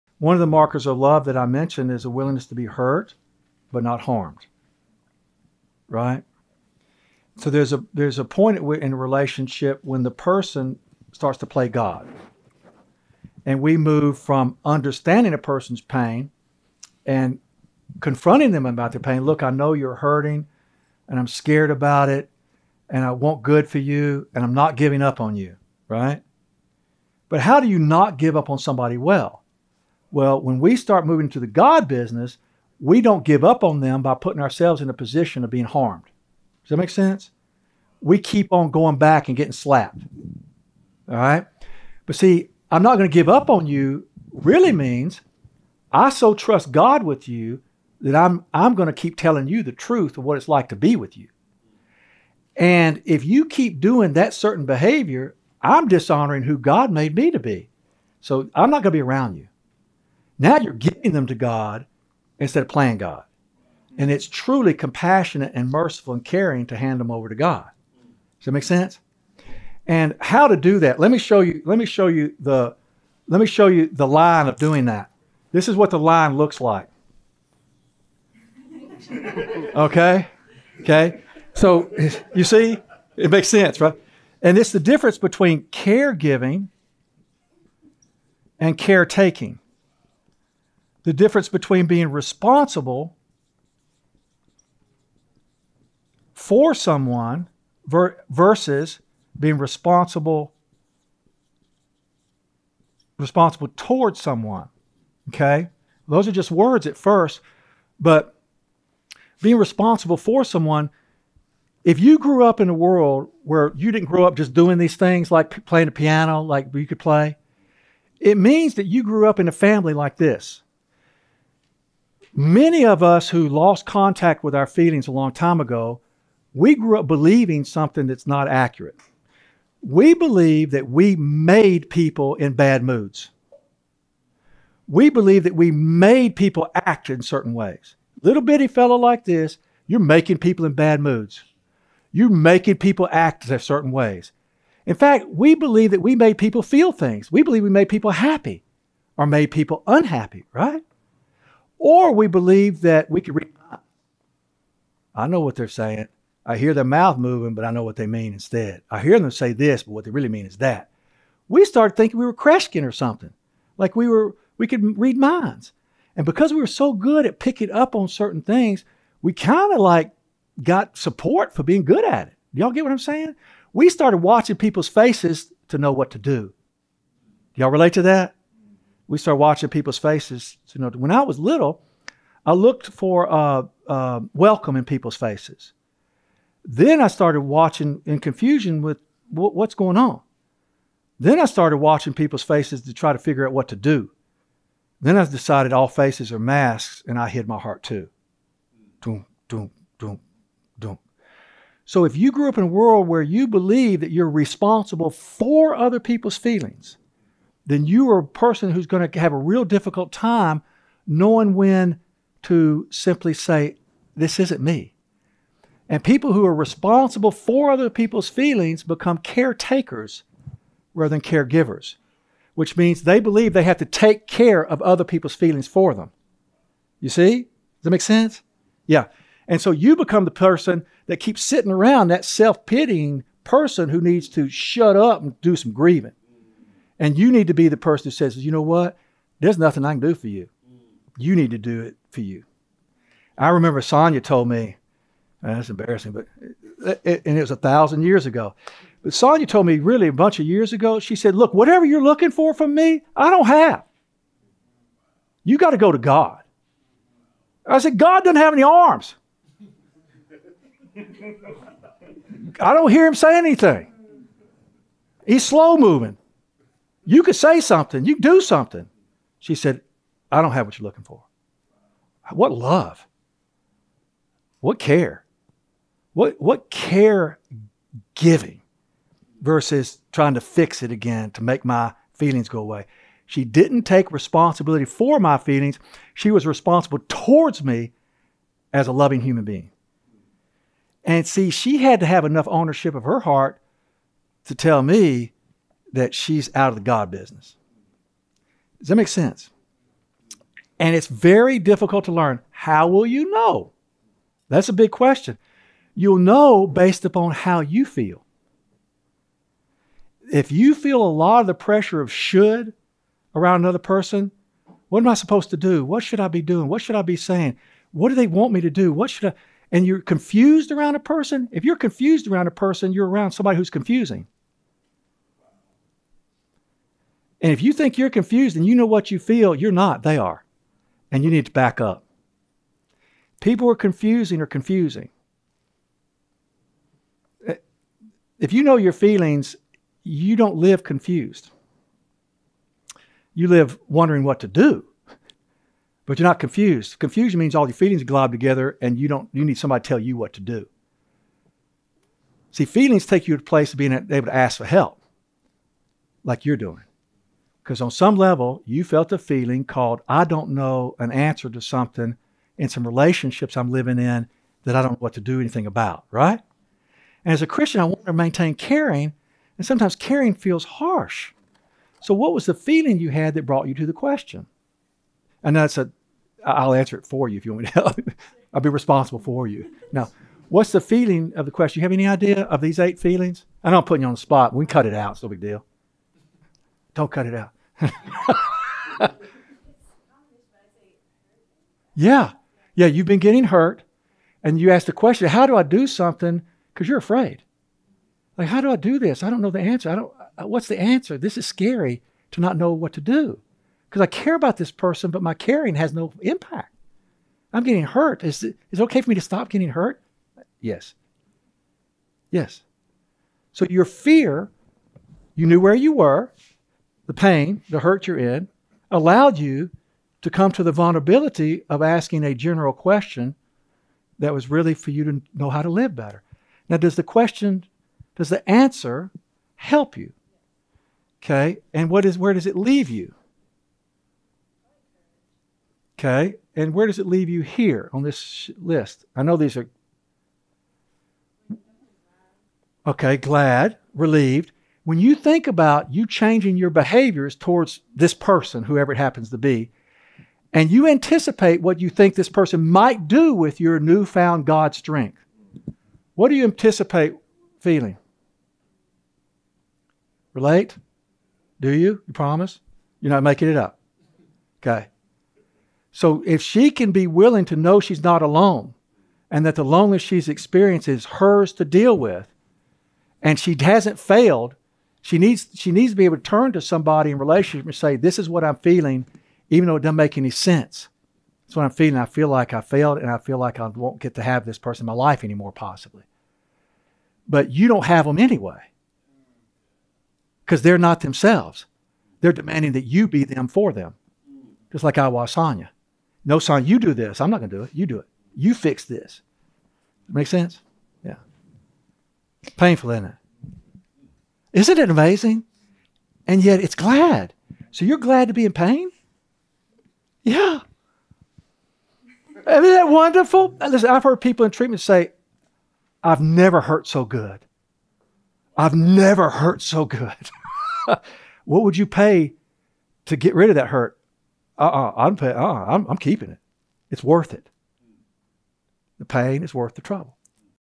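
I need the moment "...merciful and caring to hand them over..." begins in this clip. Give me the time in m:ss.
1:05.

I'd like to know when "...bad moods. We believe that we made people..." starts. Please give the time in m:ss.
2:12.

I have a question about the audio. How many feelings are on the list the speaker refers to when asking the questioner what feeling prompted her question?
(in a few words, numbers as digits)
8.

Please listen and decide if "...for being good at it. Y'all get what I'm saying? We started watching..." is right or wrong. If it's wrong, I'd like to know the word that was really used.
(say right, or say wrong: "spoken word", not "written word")
right.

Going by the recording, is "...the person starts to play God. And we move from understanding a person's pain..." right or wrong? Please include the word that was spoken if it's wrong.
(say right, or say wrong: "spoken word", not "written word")
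right.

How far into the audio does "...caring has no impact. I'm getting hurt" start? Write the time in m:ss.
6:45.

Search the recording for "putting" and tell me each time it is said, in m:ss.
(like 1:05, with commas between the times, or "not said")
0:34, 6:23.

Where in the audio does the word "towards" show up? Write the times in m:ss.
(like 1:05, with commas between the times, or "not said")
1:43, 4:47, 7:27.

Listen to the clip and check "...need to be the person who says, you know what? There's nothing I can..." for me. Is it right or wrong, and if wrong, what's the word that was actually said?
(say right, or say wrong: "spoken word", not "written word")
right.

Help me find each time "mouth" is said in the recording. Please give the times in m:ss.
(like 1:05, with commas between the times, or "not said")
2:36.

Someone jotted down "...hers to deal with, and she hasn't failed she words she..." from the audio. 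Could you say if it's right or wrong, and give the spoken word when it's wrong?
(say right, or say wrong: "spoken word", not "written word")
wrong: "needs", not "words".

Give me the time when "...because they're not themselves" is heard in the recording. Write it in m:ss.
8:10.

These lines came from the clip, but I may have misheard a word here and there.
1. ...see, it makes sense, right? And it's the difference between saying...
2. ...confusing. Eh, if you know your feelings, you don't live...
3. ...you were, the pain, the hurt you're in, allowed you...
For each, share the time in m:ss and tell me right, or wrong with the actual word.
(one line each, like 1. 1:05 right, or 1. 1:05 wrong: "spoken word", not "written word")
1. 1:22 wrong: "caregiving", not "saying"
2. 5:34 right
3. 6:55 right.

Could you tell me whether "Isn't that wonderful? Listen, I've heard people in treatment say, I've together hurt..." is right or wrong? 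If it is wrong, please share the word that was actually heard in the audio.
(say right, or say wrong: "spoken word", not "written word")
wrong: "never", not "together".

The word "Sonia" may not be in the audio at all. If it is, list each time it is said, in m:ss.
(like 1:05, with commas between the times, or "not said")
4:03, 4:09.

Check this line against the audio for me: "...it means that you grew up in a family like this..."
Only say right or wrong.
right.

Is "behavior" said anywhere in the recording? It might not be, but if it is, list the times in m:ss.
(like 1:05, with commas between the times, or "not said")
0:54, 7:26.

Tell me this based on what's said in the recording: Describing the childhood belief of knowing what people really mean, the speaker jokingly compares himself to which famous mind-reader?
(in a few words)
Kreskin.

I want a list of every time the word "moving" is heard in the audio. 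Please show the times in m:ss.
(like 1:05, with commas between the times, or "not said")
0:31, 2:37, 4:25.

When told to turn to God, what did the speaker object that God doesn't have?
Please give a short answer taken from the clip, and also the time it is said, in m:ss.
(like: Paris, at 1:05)
arms, at 4:18.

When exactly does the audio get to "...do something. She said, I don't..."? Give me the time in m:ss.
4:28.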